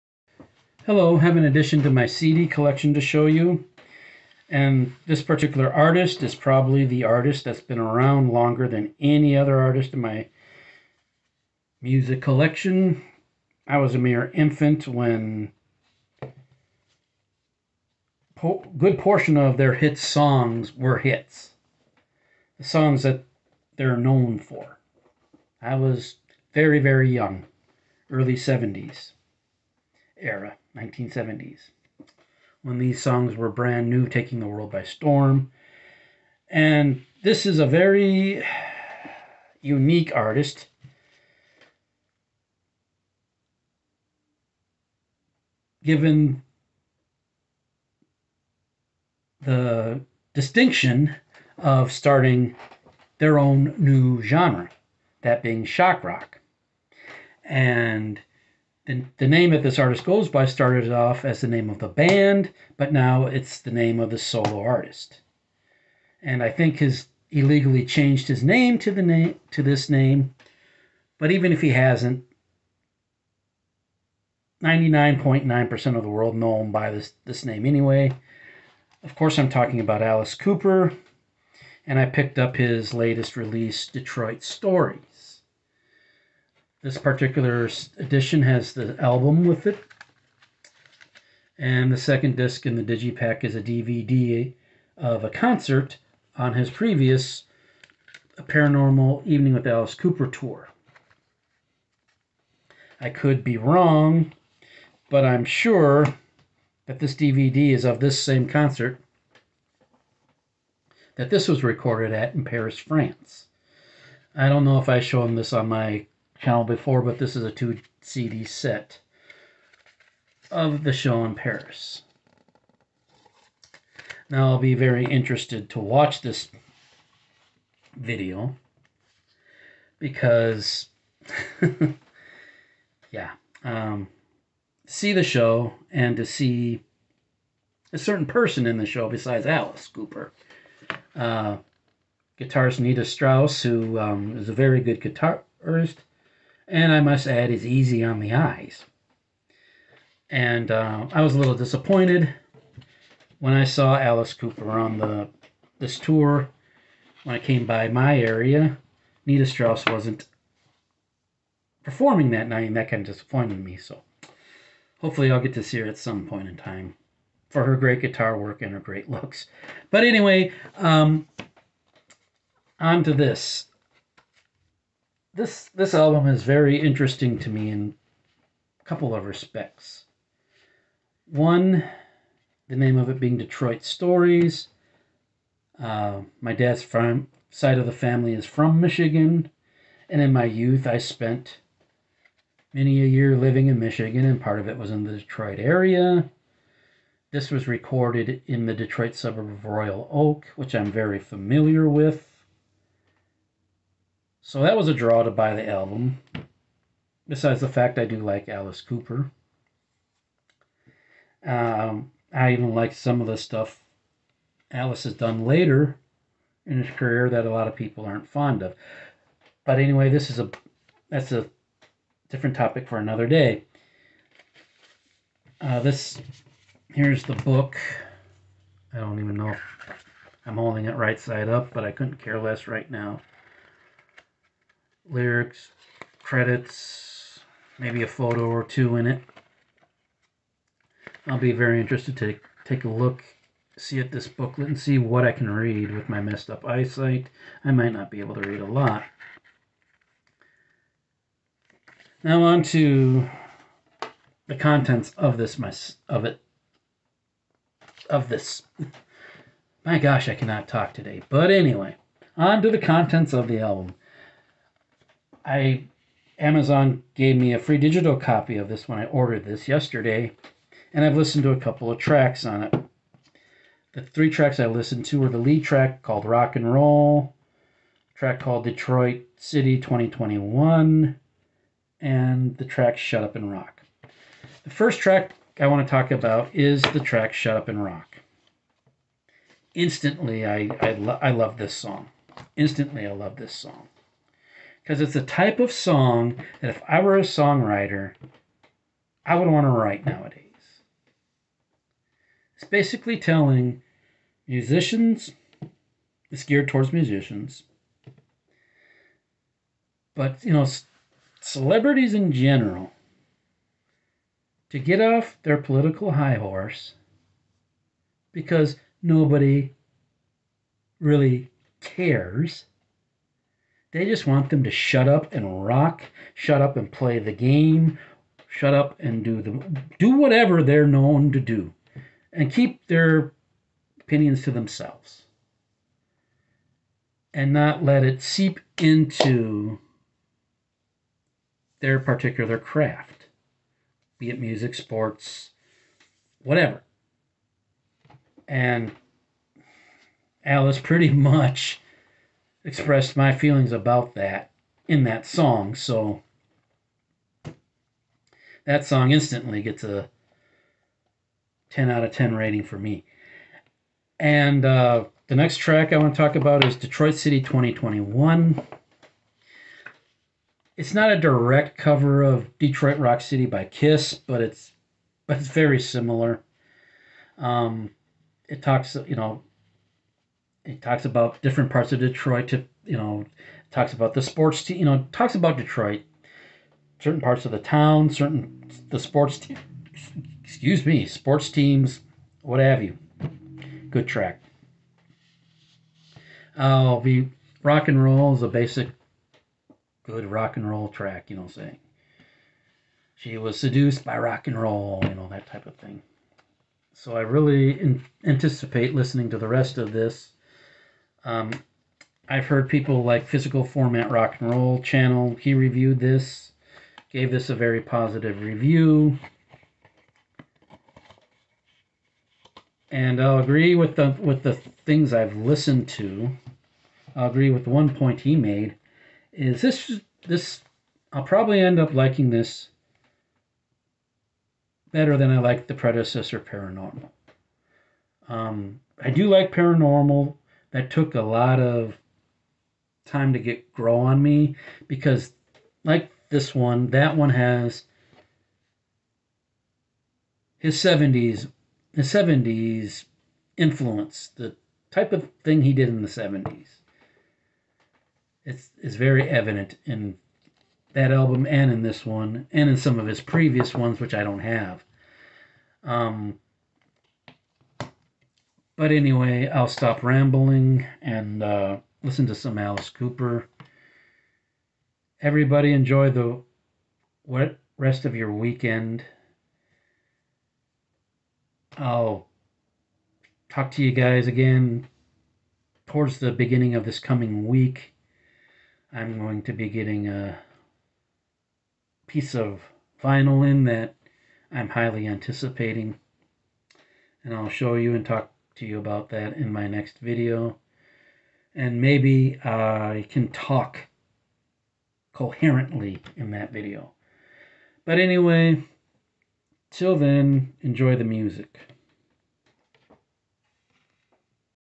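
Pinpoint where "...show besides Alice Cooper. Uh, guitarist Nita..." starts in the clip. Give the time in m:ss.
2:18.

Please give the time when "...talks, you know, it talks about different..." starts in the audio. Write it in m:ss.
6:18.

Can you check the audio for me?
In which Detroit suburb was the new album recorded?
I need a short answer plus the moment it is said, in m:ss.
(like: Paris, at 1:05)
Royal Oak, at 3:19.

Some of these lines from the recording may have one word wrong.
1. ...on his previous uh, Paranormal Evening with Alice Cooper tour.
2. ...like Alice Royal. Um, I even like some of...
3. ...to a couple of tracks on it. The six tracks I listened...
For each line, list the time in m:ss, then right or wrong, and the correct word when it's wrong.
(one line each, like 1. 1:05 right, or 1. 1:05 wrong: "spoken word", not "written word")
1. 1:36 right
2. 3:28 wrong: "Cooper", not "Royal"
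3. 4:31 wrong: "three", not "six".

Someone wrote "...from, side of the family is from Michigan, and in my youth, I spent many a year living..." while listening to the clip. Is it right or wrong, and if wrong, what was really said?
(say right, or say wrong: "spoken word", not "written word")
right.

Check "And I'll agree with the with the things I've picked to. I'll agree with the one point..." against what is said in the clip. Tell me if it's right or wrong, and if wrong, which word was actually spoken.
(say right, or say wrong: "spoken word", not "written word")
wrong: "listened", not "picked".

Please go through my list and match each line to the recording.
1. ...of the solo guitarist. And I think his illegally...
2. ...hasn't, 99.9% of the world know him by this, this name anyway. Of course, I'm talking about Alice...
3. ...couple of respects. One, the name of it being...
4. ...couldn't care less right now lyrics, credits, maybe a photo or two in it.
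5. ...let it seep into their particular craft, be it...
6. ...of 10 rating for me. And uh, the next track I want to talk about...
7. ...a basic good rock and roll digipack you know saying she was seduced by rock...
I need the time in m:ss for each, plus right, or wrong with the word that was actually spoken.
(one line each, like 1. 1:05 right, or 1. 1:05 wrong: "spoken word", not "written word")
1. 1:03 wrong: "artist", not "guitarist"
2. 1:11 right
3. 2:58 right
4. 3:51 right
5. 5:37 right
6. 6:02 right
7. 6:38 wrong: "track", not "digipack".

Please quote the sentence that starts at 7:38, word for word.
It's is very evident in that album and in this one and in some of his previous ones which I don't have.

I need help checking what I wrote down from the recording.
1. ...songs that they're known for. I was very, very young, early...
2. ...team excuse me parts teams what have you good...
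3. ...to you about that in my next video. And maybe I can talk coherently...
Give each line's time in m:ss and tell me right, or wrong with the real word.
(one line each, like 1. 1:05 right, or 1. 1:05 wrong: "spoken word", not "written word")
1. 0:22 right
2. 6:29 wrong: "sports", not "parts"
3. 8:18 right.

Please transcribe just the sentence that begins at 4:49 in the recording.
Instantly, I, I, lo- I love this song.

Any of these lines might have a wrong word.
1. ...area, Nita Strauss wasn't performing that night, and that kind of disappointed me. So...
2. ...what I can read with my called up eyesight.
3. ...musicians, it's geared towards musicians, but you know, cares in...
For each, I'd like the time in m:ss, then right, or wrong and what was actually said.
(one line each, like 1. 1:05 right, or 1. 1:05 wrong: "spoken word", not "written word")
1. 2:38 right
2. 4:04 wrong: "messed", not "called"
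3. 5:04 wrong: "celebrities", not "cares".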